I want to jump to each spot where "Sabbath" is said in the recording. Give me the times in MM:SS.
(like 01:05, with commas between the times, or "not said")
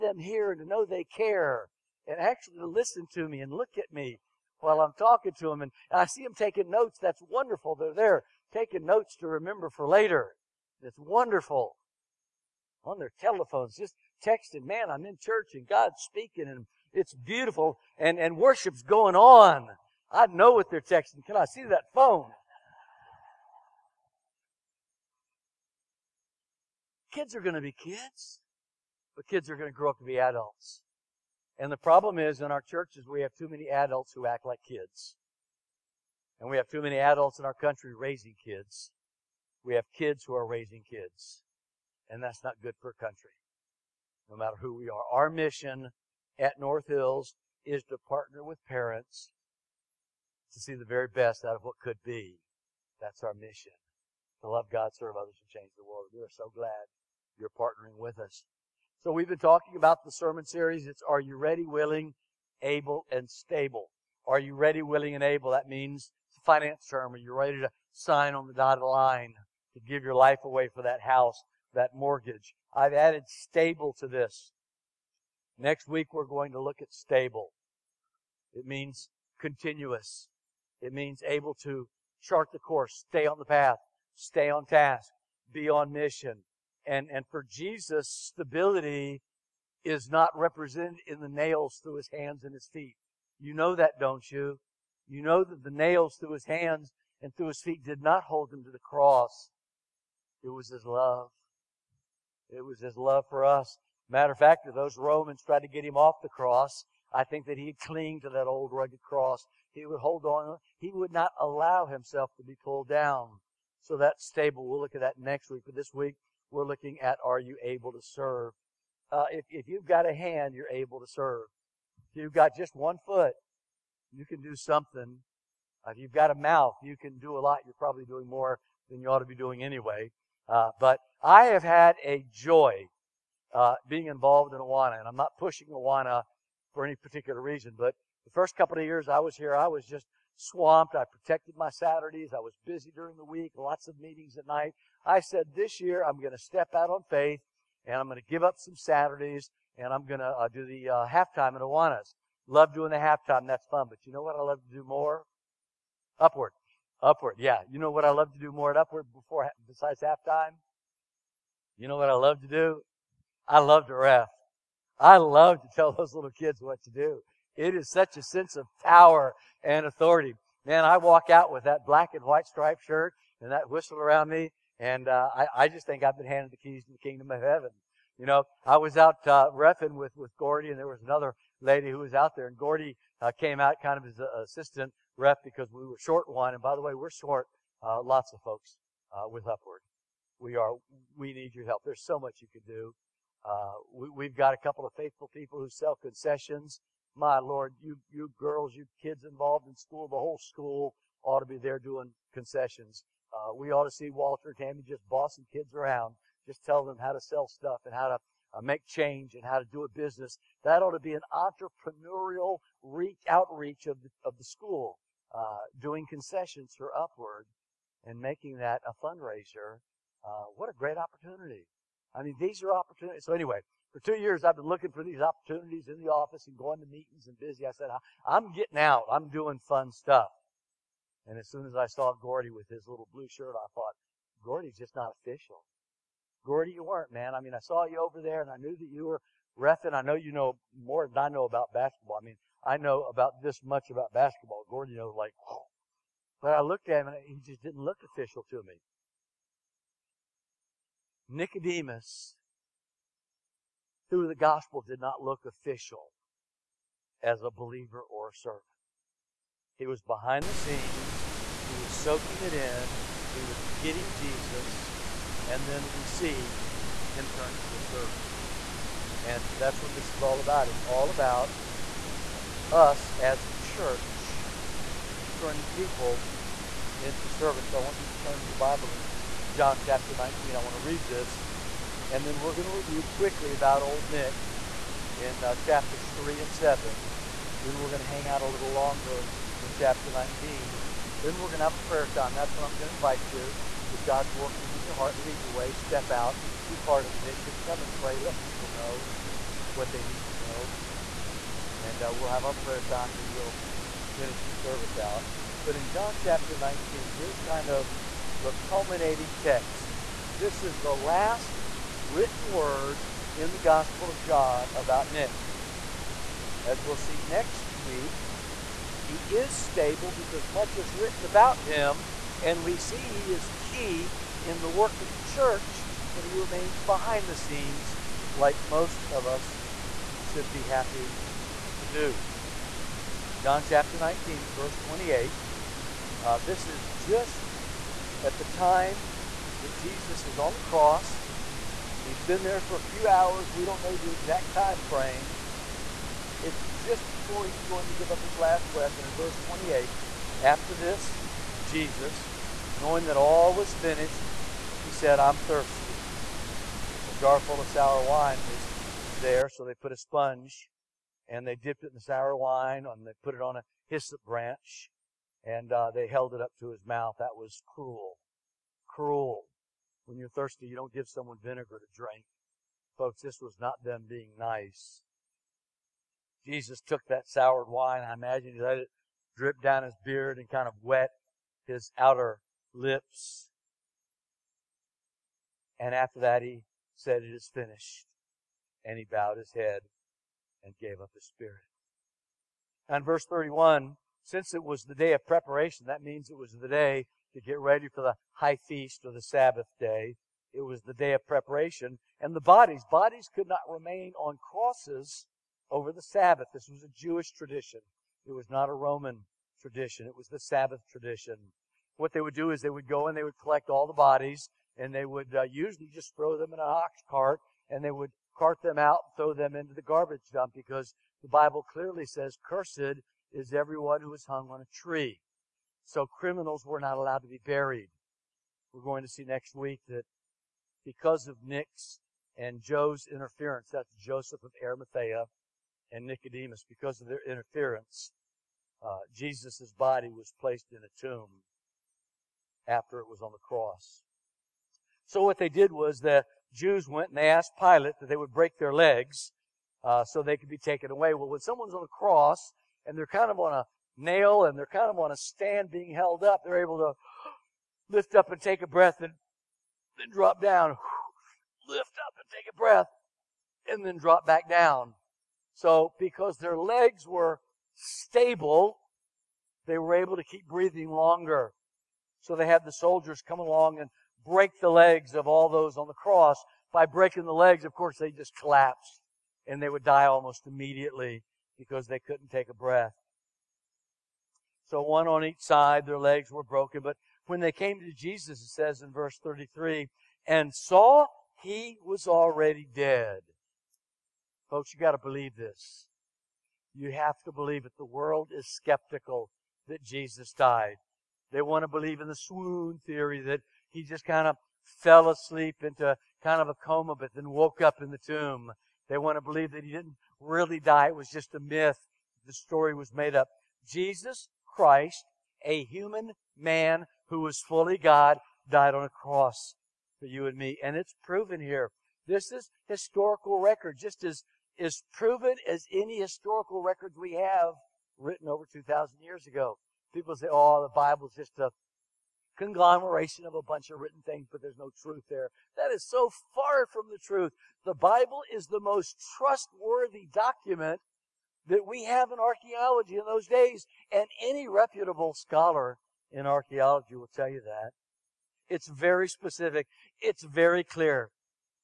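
06:39, 06:46, 06:50.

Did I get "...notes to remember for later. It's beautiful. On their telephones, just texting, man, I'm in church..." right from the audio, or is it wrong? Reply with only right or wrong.
wrong.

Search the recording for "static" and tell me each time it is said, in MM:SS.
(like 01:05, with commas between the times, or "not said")
not said.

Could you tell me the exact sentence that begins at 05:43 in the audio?
We don't know the exact time frame.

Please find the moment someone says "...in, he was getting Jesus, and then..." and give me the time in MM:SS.
04:22.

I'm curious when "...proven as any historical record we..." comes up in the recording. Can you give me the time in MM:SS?
08:44.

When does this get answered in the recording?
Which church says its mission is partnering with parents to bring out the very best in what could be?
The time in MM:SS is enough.
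00:46.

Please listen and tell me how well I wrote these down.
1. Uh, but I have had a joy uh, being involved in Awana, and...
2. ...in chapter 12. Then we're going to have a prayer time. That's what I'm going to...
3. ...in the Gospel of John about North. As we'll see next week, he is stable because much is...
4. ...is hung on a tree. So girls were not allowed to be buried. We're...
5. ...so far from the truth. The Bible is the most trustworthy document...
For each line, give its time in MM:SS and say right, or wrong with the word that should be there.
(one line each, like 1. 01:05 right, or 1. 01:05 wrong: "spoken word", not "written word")
1. 02:10 right
2. 04:49 wrong: "19", not "12"
3. 05:13 wrong: "Nick", not "North"
4. 07:04 wrong: "criminals", not "girls"
5. 08:55 right.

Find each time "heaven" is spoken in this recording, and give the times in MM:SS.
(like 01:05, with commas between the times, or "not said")
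02:57.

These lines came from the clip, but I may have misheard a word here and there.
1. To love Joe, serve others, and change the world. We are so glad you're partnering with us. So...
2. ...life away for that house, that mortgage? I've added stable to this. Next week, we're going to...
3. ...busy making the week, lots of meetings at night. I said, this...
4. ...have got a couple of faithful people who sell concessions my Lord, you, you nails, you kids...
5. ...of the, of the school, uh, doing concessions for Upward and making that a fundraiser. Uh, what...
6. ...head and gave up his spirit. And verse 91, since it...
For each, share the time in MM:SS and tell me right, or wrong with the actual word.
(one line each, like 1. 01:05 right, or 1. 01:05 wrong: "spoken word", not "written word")
1. 00:54 wrong: "God", not "Joe"
2. 01:10 right
3. 02:22 wrong: "during", not "making"
4. 03:14 wrong: "girls", not "nails"
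5. 03:33 right
6. 06:29 wrong: "31", not "91".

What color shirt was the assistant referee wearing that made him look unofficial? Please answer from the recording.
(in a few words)
Blue.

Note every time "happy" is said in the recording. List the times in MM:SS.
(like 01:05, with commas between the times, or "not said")
05:30.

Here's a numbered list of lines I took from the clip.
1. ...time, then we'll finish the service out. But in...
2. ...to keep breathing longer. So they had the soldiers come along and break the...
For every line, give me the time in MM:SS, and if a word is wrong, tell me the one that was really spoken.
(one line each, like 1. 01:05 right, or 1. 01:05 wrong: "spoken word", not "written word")
1. 05:02 right
2. 07:50 right.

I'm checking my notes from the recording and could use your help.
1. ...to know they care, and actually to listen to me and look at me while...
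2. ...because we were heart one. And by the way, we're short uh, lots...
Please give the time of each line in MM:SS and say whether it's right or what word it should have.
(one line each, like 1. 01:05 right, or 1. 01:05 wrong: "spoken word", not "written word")
1. 00:00 right
2. 03:05 wrong: "short", not "heart".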